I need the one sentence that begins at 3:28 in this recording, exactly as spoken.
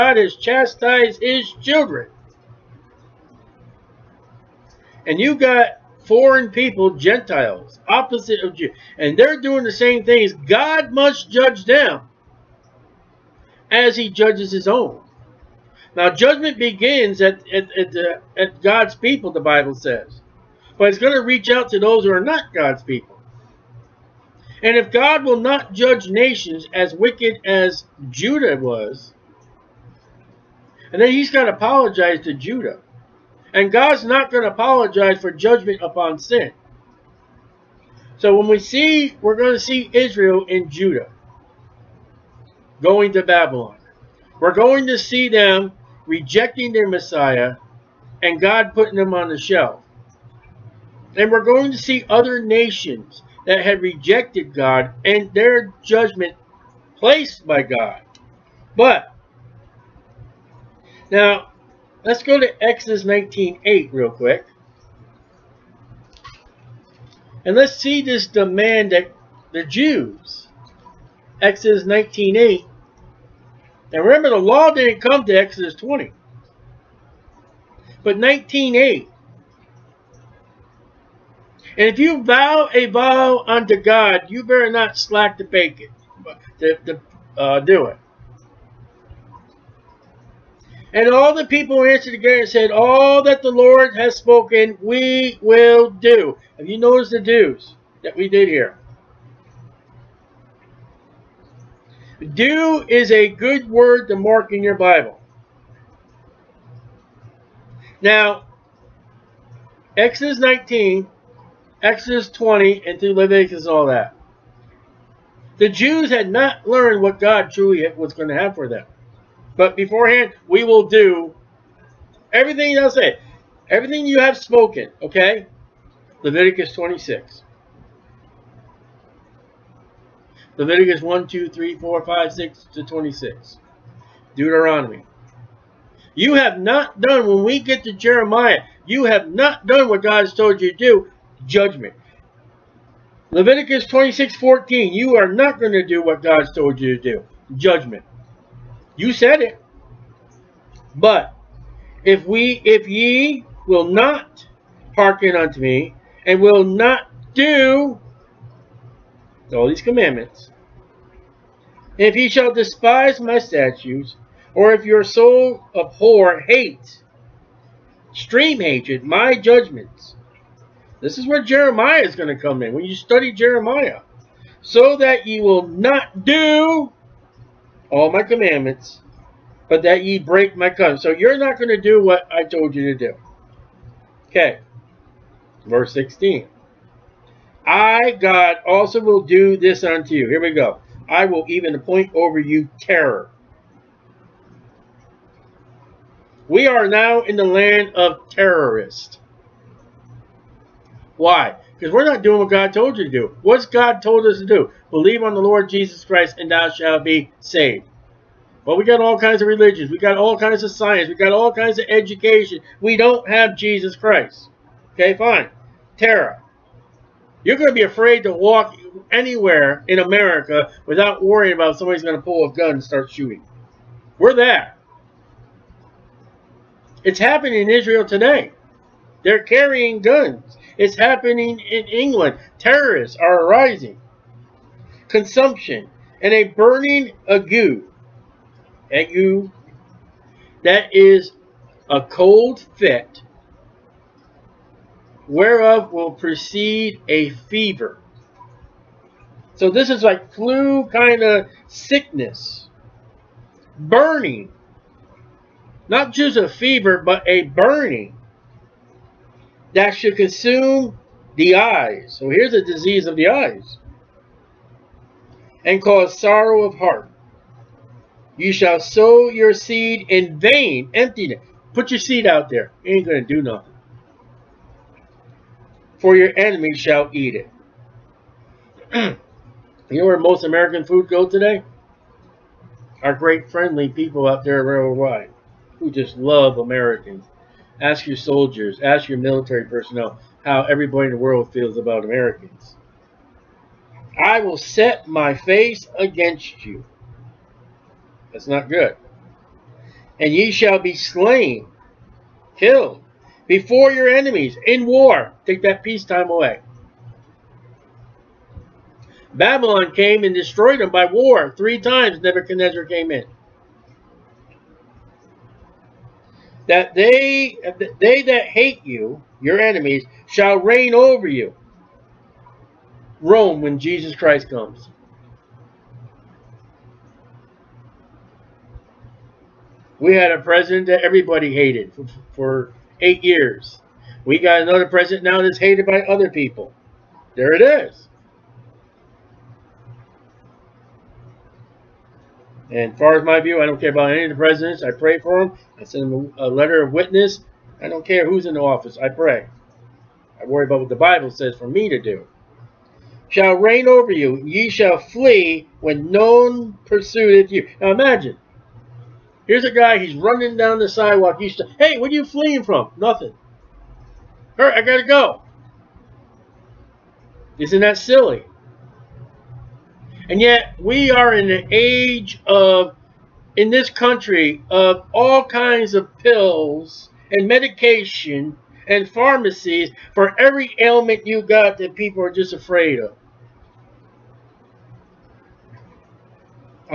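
But we got all kinds of religions.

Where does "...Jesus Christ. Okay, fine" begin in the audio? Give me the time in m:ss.
3:33.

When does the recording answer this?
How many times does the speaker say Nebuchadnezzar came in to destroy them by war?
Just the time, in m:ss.
5:11.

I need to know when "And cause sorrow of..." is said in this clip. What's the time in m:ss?
4:25.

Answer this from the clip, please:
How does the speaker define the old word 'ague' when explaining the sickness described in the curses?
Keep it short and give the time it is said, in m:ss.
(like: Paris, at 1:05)
A cold fit, at 4:01.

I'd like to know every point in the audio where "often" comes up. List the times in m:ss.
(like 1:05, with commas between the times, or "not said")
not said.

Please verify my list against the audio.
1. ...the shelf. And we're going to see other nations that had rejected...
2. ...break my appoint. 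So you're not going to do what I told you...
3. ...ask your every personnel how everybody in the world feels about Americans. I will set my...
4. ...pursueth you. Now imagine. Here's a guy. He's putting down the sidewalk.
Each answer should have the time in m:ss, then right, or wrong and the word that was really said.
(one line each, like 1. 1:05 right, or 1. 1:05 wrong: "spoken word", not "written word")
1. 0:49 right
2. 3:00 wrong: "covenant", not "appoint"
3. 4:48 wrong: "military", not "every"
4. 5:56 wrong: "running", not "putting".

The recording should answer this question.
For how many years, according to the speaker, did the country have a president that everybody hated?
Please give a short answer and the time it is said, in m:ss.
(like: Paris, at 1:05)
8, at 5:32.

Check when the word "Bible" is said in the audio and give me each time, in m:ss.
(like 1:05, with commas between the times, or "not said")
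0:19, 1:44, 5:50.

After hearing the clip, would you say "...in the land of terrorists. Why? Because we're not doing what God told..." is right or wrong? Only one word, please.
right.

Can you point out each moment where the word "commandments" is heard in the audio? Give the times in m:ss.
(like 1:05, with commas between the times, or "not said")
2:39, 2:58.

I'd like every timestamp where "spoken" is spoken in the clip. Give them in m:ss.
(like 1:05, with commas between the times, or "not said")
1:34, 2:04.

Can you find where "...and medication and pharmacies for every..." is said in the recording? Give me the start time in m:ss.
6:17.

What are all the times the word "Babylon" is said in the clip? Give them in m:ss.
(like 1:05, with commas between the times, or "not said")
0:43, 5:09.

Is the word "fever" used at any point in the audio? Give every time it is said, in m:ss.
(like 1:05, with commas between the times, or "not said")
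4:07, 4:16.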